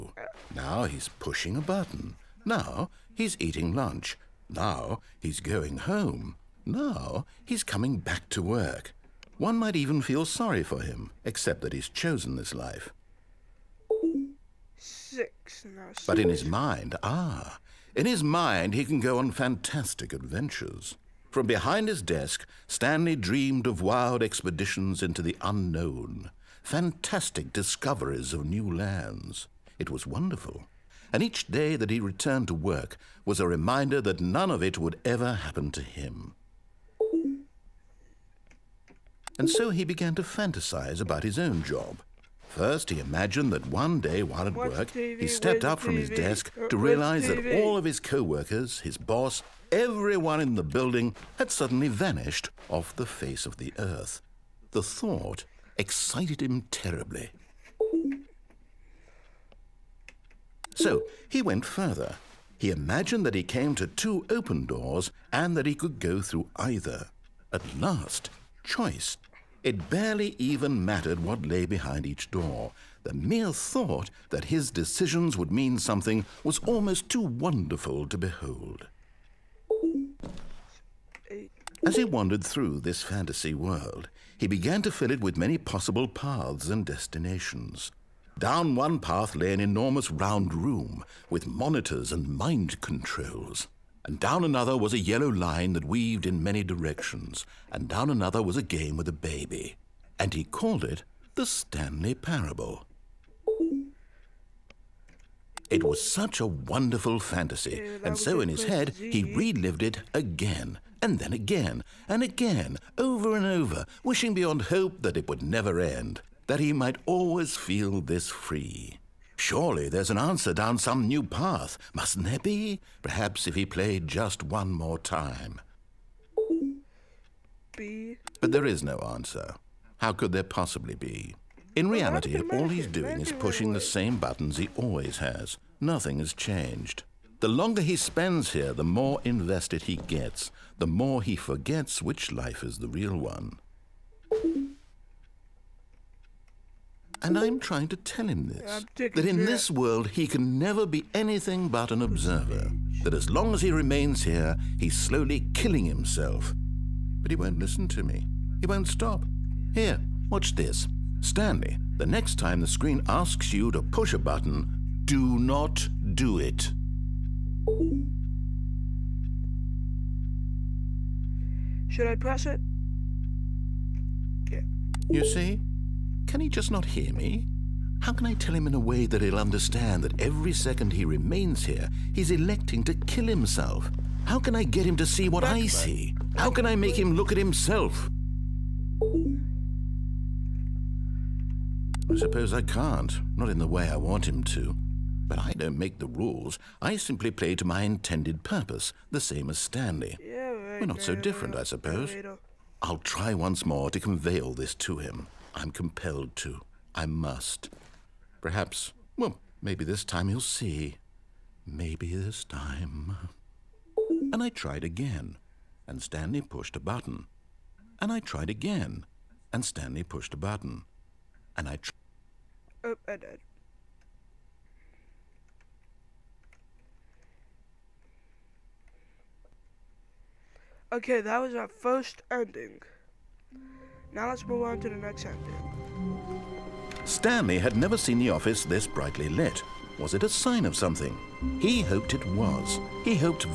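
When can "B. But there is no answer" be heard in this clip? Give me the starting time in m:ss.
2:07.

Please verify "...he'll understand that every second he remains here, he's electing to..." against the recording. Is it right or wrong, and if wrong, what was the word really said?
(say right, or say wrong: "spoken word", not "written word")
right.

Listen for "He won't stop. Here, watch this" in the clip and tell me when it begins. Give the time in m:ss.
2:38.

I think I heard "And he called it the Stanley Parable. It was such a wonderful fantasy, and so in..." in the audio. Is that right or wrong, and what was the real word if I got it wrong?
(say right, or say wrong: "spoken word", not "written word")
right.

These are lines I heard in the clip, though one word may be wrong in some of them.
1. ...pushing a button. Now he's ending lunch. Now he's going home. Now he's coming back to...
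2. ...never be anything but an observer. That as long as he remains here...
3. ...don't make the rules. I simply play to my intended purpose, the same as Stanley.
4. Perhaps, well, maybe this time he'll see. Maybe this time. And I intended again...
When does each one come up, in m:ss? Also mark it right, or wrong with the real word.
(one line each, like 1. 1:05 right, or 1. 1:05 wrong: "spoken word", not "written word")
1. 0:01 wrong: "eating", not "ending"
2. 2:30 right
3. 3:15 right
4. 3:28 wrong: "tried", not "intended".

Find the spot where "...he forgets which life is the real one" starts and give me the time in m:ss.
2:21.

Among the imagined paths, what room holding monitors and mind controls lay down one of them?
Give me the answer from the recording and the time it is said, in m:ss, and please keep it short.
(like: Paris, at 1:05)
enormous round room, at 1:29.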